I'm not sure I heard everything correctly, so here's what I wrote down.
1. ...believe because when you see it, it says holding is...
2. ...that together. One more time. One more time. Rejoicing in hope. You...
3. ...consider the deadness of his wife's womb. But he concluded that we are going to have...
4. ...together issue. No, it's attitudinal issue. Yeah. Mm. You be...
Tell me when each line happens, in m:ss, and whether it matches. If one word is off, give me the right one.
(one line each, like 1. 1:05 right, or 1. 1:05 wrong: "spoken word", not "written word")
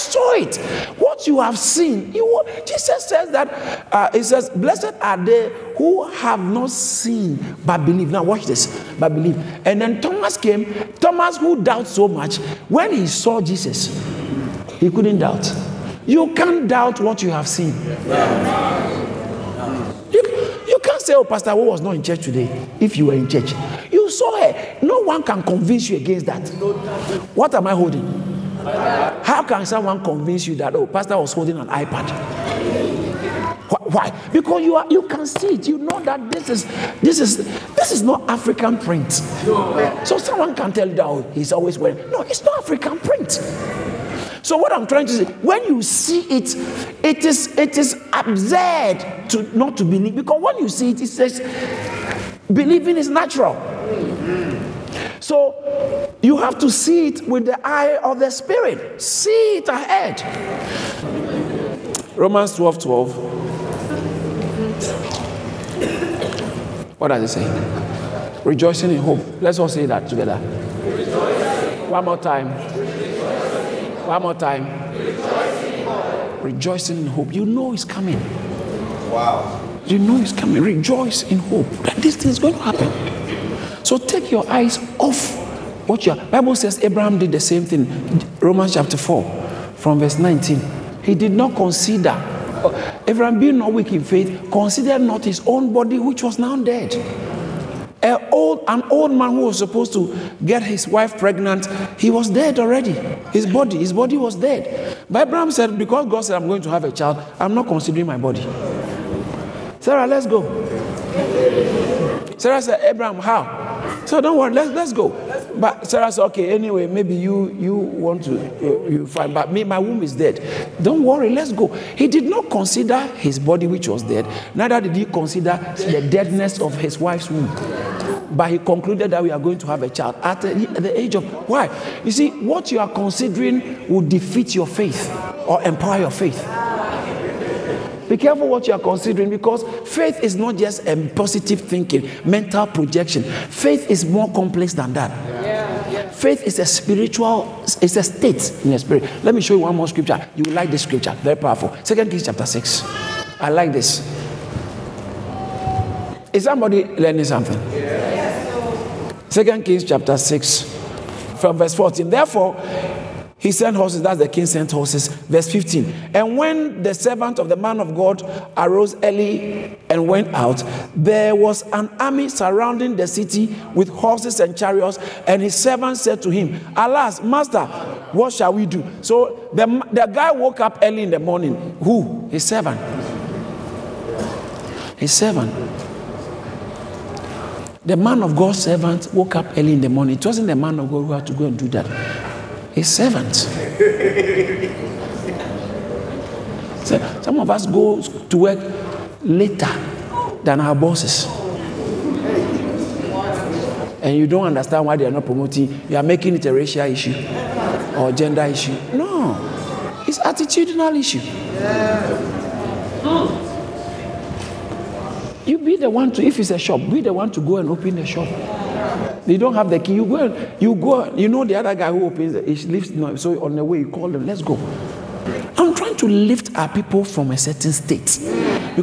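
1. 0:49 wrong: "believing", not "holding"
2. 1:09 right
3. 2:05 right
4. 3:28 wrong: "gender", not "together".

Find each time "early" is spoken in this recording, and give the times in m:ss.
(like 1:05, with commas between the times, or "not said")
2:49, 3:00, 3:09.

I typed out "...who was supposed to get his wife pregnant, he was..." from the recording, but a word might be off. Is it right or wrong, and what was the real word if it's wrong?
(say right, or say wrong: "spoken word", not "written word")
right.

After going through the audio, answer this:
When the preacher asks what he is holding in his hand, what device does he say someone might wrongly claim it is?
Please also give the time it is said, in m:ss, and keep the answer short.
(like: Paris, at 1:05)
iPad, at 0:31.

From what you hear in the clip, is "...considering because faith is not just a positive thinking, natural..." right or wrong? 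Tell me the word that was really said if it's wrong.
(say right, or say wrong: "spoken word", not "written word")
wrong: "mental", not "natural".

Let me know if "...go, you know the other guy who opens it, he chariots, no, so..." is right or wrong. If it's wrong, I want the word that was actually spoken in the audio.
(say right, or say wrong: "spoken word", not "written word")
wrong: "lifts", not "chariots".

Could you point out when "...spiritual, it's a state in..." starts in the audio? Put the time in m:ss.
2:26.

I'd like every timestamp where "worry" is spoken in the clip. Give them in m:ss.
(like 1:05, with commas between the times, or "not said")
1:54, 2:01.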